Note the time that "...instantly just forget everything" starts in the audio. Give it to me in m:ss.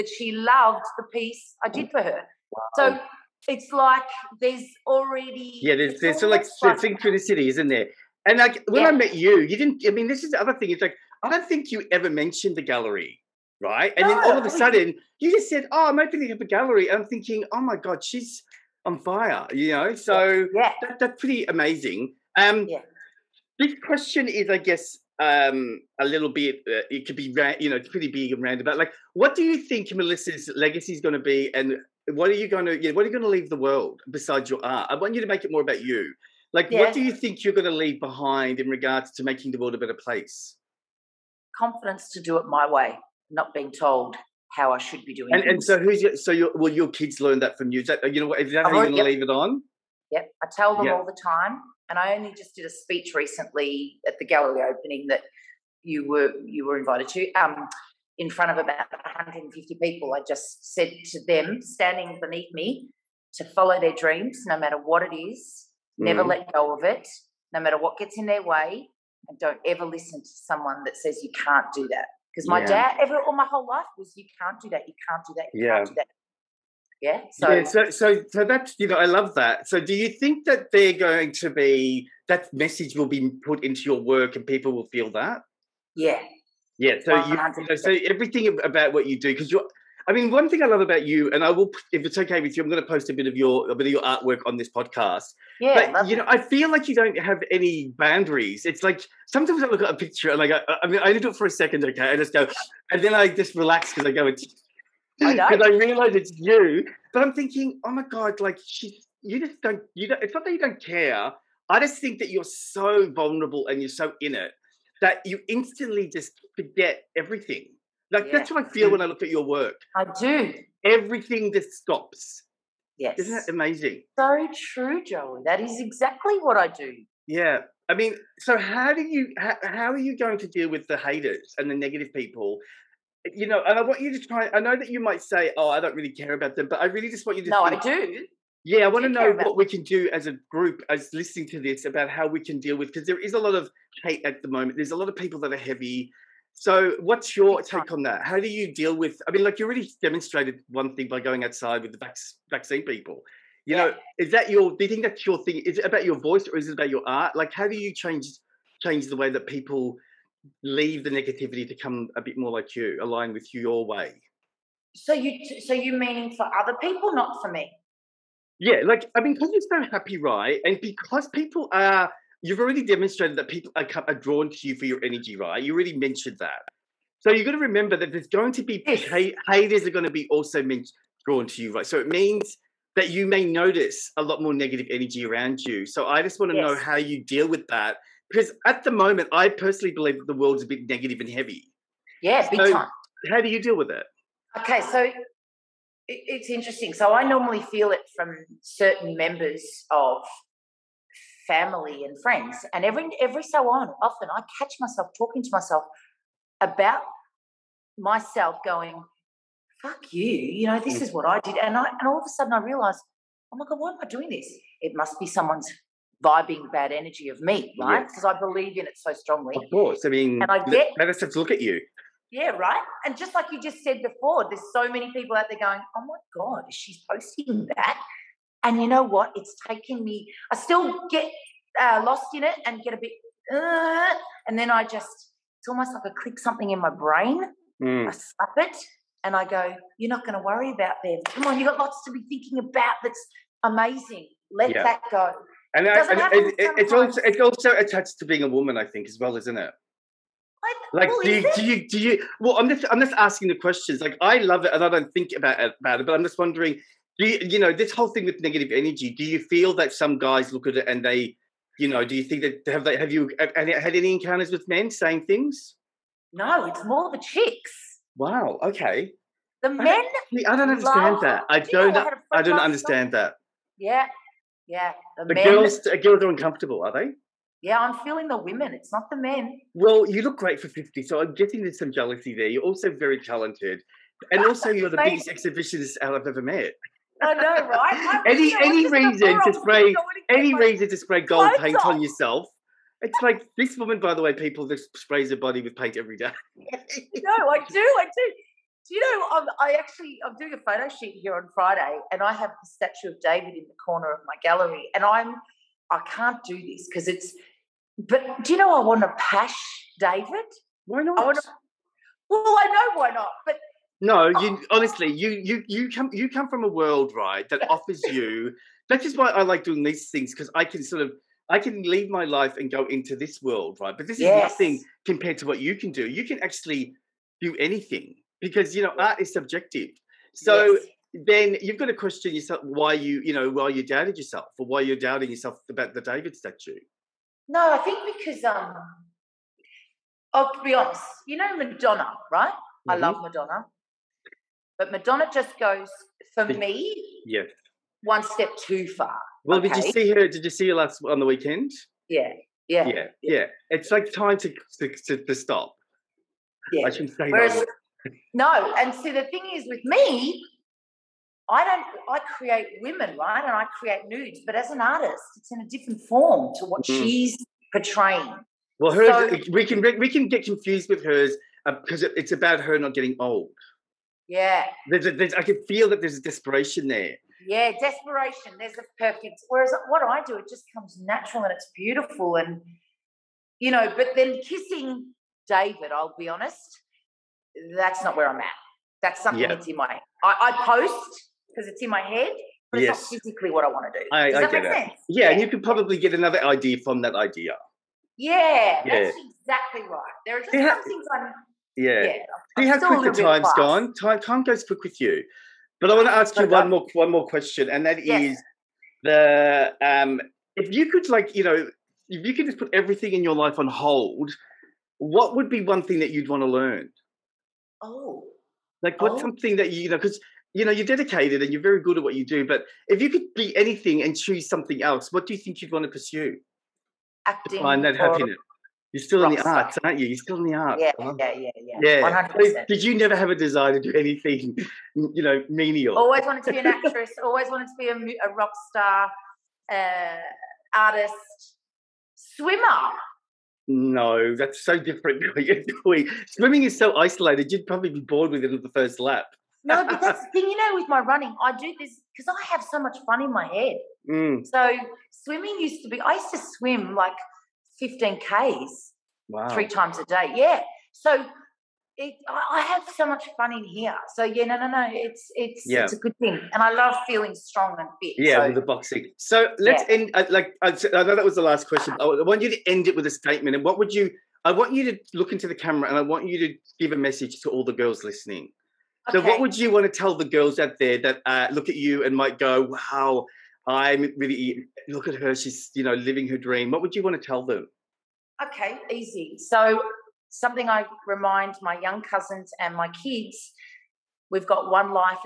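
1:55.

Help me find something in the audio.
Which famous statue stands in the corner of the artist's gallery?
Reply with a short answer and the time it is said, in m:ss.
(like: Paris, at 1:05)
Statue of David, at 5:02.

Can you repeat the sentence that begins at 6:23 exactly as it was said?
But then kissing David, I'll be honest, that's not where I'm at.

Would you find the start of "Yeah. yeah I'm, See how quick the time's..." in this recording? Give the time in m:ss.
6:41.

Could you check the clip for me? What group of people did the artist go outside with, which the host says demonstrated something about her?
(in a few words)
Vaccine people.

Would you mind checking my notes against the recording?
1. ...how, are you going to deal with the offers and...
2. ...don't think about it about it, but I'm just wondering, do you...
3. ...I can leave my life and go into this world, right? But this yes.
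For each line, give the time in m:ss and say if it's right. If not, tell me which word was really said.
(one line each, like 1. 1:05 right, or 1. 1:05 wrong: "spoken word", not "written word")
1. 2:09 wrong: "haters", not "offers"
2. 4:14 right
3. 5:21 right.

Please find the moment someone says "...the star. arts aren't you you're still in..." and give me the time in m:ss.
7:09.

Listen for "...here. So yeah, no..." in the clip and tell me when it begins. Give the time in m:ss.
7:43.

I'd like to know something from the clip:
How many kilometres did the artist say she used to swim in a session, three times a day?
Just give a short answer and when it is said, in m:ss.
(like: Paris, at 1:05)
15, at 7:37.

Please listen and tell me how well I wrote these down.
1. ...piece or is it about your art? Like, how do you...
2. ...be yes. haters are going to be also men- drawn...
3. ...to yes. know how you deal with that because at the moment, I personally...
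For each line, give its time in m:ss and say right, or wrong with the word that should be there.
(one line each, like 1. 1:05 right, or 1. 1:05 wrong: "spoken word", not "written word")
1. 2:36 wrong: "voice", not "piece"
2. 2:58 right
3. 3:06 right.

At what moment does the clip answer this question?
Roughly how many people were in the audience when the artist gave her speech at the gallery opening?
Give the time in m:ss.
0:58.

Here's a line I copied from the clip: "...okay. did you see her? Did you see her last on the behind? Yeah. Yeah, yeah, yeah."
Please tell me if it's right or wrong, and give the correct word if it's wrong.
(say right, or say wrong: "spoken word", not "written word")
wrong: "weekend", not "behind".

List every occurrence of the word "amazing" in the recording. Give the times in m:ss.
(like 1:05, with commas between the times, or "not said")
0:21, 2:03, 4:03.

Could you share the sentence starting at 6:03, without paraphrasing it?
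And I create nudes, but as an artist, it's in a different form to what mm.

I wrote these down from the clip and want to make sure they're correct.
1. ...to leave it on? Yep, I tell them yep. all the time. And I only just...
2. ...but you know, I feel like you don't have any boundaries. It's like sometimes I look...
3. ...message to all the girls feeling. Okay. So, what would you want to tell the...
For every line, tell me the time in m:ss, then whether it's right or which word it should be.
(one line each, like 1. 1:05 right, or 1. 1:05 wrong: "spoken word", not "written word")
1. 0:48 right
2. 1:35 right
3. 7:56 wrong: "listening", not "feeling".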